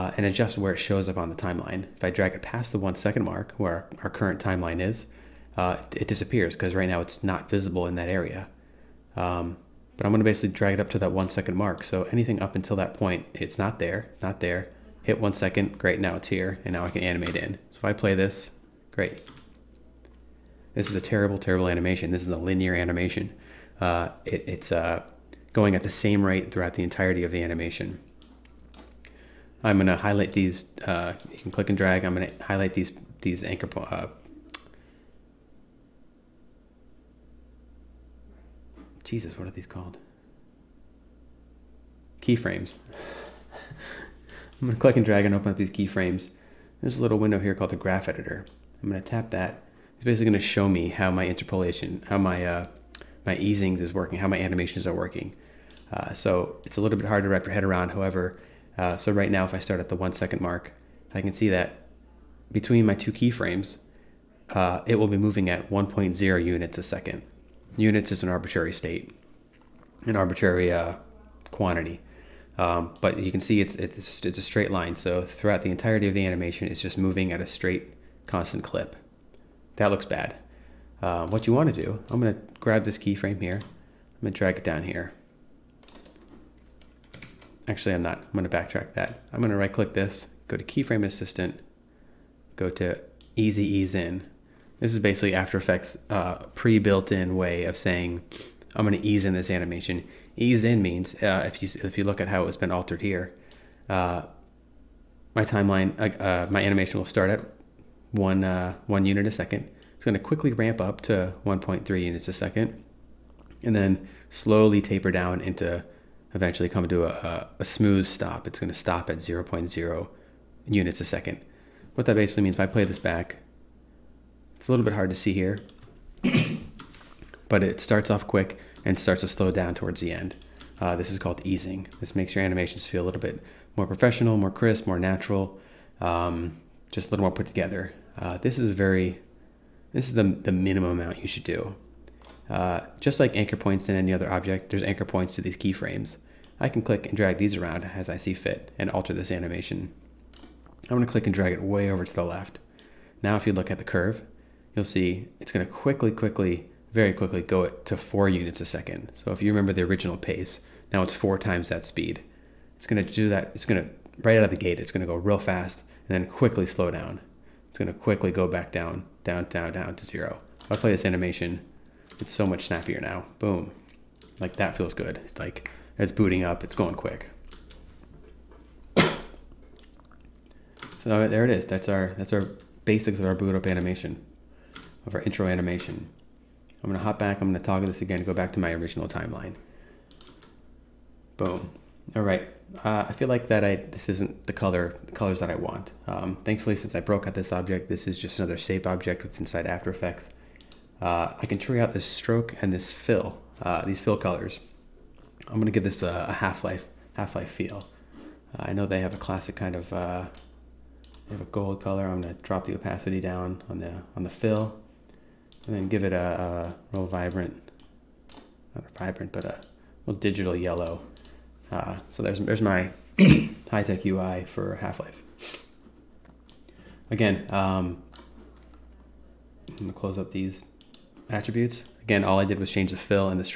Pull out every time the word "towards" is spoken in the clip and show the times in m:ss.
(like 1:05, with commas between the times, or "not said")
2:09.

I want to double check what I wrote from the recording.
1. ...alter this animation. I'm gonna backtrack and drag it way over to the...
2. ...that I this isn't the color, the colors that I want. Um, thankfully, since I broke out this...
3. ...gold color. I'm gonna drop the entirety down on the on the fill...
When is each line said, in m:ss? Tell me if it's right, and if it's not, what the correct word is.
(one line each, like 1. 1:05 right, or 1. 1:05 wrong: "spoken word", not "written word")
1. 2:28 wrong: "click", not "backtrack"
2. 3:13 right
3. 3:31 wrong: "opacity", not "entirety".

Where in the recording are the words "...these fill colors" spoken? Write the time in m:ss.
3:23.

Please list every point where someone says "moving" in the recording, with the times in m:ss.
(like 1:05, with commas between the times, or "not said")
1:05, 1:16.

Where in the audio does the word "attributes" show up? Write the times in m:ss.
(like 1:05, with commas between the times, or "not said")
3:51.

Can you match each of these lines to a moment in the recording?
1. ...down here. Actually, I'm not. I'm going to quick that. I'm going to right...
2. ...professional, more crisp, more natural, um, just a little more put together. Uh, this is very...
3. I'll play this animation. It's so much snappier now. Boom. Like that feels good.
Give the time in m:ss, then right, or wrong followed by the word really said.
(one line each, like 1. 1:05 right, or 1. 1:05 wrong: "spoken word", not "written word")
1. 1:24 wrong: "backtrack", not "quick"
2. 2:13 right
3. 2:50 right.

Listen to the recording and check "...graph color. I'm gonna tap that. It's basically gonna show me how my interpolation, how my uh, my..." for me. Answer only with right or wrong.
wrong.